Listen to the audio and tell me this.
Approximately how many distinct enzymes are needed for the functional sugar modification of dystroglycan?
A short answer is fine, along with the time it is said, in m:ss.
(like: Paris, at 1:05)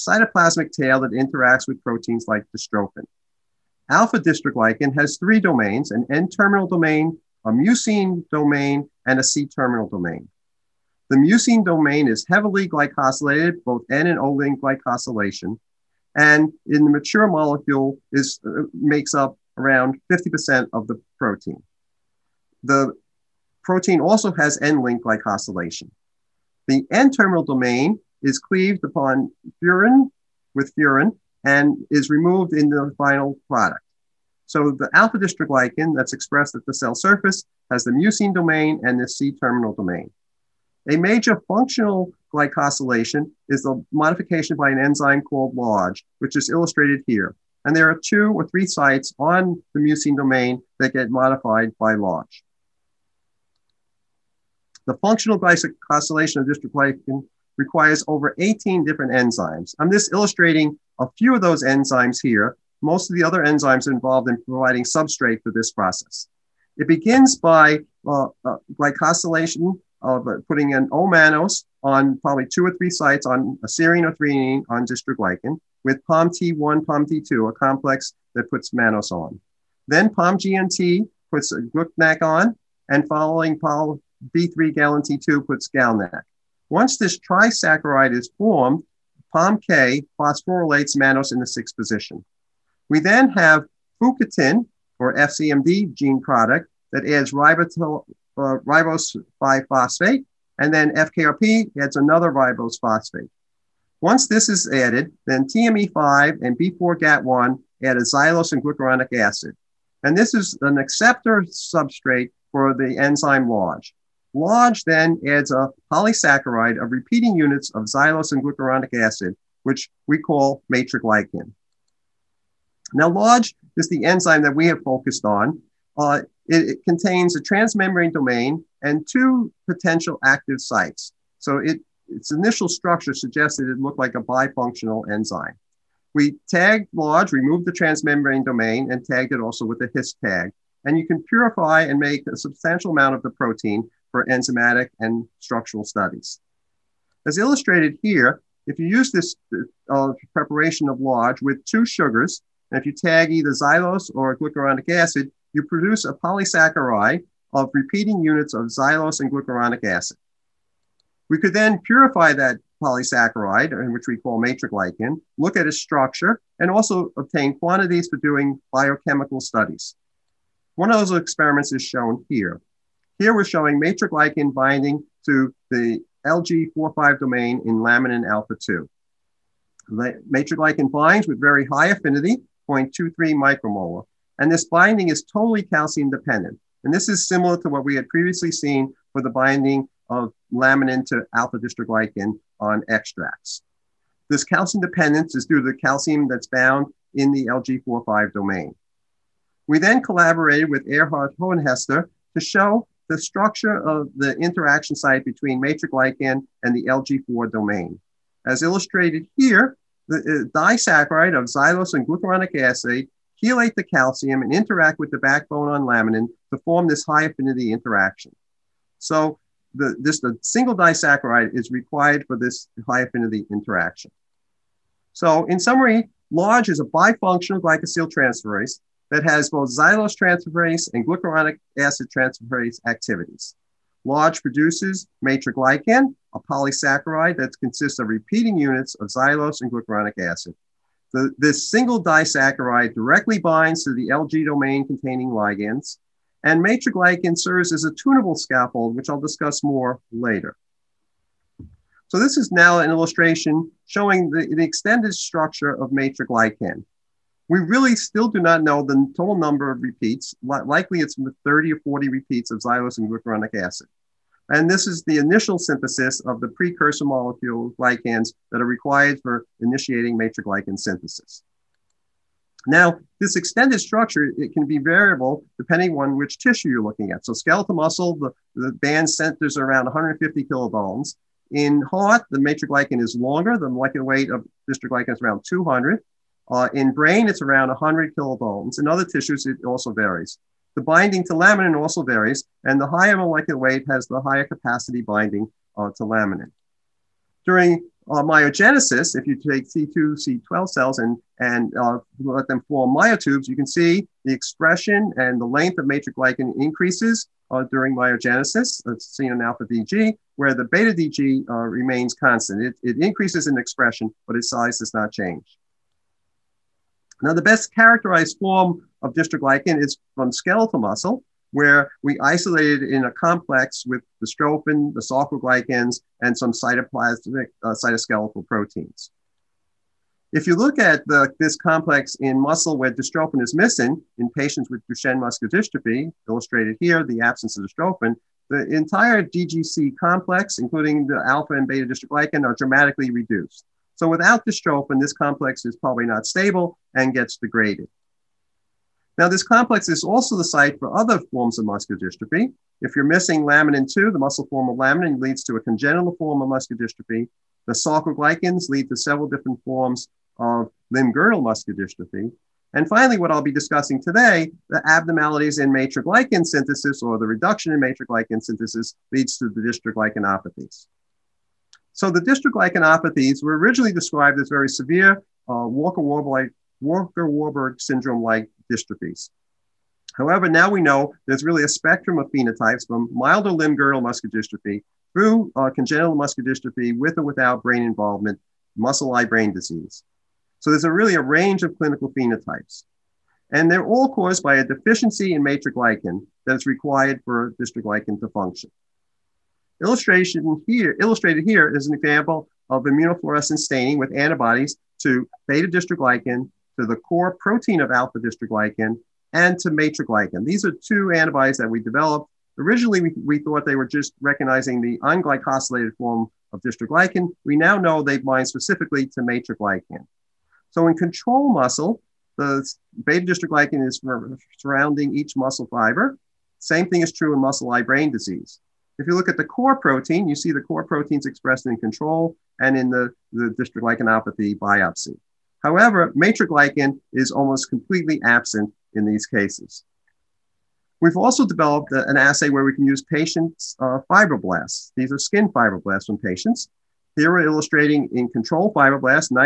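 over 18, at 0:58.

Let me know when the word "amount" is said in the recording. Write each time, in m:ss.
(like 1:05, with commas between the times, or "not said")
2:22.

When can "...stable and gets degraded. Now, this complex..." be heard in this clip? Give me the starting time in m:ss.
5:46.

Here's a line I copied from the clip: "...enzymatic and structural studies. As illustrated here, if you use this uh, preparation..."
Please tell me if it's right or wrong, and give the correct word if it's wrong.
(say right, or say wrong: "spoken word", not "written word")
right.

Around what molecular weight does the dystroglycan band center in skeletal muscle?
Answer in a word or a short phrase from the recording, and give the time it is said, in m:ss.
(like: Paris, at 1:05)
150 kilodaltons, at 4:39.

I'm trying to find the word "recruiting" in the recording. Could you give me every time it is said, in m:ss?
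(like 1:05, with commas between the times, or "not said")
not said.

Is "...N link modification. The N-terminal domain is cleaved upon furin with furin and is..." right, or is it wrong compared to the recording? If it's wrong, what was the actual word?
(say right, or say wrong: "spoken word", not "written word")
wrong: "glycosylation", not "modification".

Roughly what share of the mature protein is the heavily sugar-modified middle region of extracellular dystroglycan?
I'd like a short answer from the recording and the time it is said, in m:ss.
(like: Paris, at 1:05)
50%, at 0:20.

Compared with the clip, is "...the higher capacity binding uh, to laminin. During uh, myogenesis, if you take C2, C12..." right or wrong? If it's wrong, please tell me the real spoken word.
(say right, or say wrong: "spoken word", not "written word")
right.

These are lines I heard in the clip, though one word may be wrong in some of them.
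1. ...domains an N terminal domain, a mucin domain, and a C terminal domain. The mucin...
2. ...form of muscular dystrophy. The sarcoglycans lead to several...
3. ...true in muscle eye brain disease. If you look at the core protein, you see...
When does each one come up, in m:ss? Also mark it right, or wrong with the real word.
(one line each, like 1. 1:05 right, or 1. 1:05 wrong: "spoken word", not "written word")
1. 0:05 right
2. 5:56 right
3. 7:07 right.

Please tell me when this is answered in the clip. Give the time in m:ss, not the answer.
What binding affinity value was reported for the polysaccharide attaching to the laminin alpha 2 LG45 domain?
3:02.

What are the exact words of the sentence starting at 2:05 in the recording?
Uh, it, it, contains a transmembrane domain and two potential active sites.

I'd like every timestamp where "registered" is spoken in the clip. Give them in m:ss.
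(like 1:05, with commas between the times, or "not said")
not said.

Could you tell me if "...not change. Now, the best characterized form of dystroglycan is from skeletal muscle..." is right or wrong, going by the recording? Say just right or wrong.
right.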